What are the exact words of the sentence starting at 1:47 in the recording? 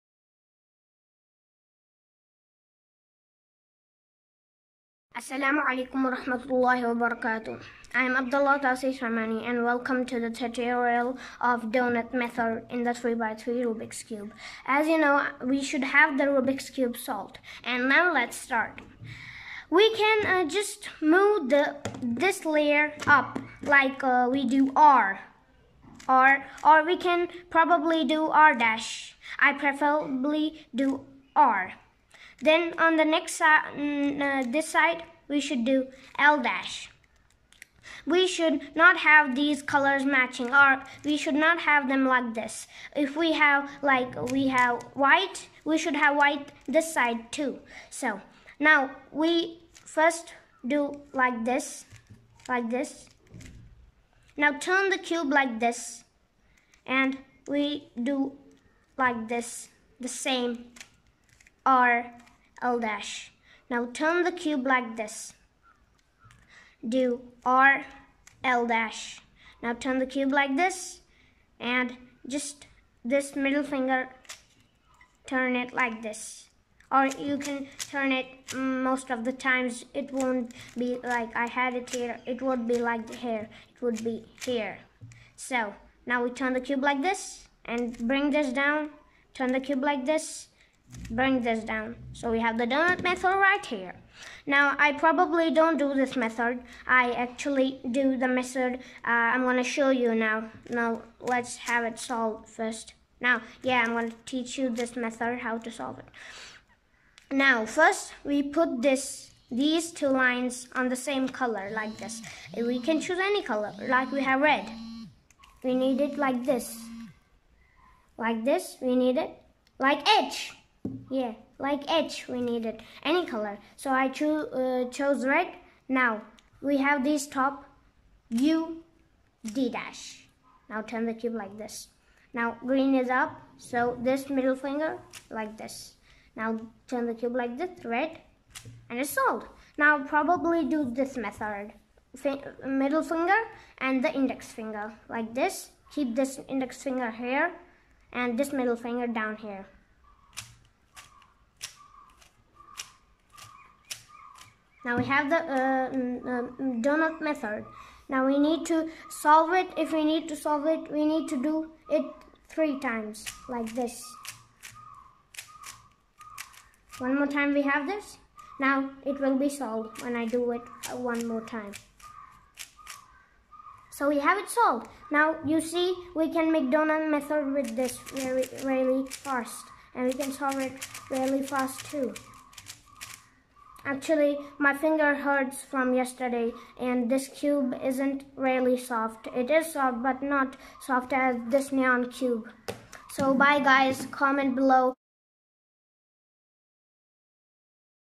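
Now first we put this these two lines on the same color like this.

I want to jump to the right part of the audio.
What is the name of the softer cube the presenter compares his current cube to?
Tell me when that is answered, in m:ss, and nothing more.
3:11.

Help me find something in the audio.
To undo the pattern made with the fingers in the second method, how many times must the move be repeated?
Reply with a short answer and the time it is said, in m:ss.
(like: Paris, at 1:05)
3, at 2:42.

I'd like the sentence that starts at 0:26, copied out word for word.
R, or we can probably do R dash.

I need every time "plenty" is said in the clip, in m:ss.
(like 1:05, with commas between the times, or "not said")
not said.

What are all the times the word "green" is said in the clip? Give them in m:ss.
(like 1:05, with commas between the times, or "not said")
2:12.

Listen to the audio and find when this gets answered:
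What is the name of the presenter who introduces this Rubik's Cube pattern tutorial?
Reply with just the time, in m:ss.
0:08.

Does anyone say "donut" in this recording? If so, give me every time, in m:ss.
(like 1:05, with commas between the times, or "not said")
0:11, 1:32, 2:36, 2:56.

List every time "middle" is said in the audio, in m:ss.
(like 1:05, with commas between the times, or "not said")
1:13, 2:14, 2:22, 2:28.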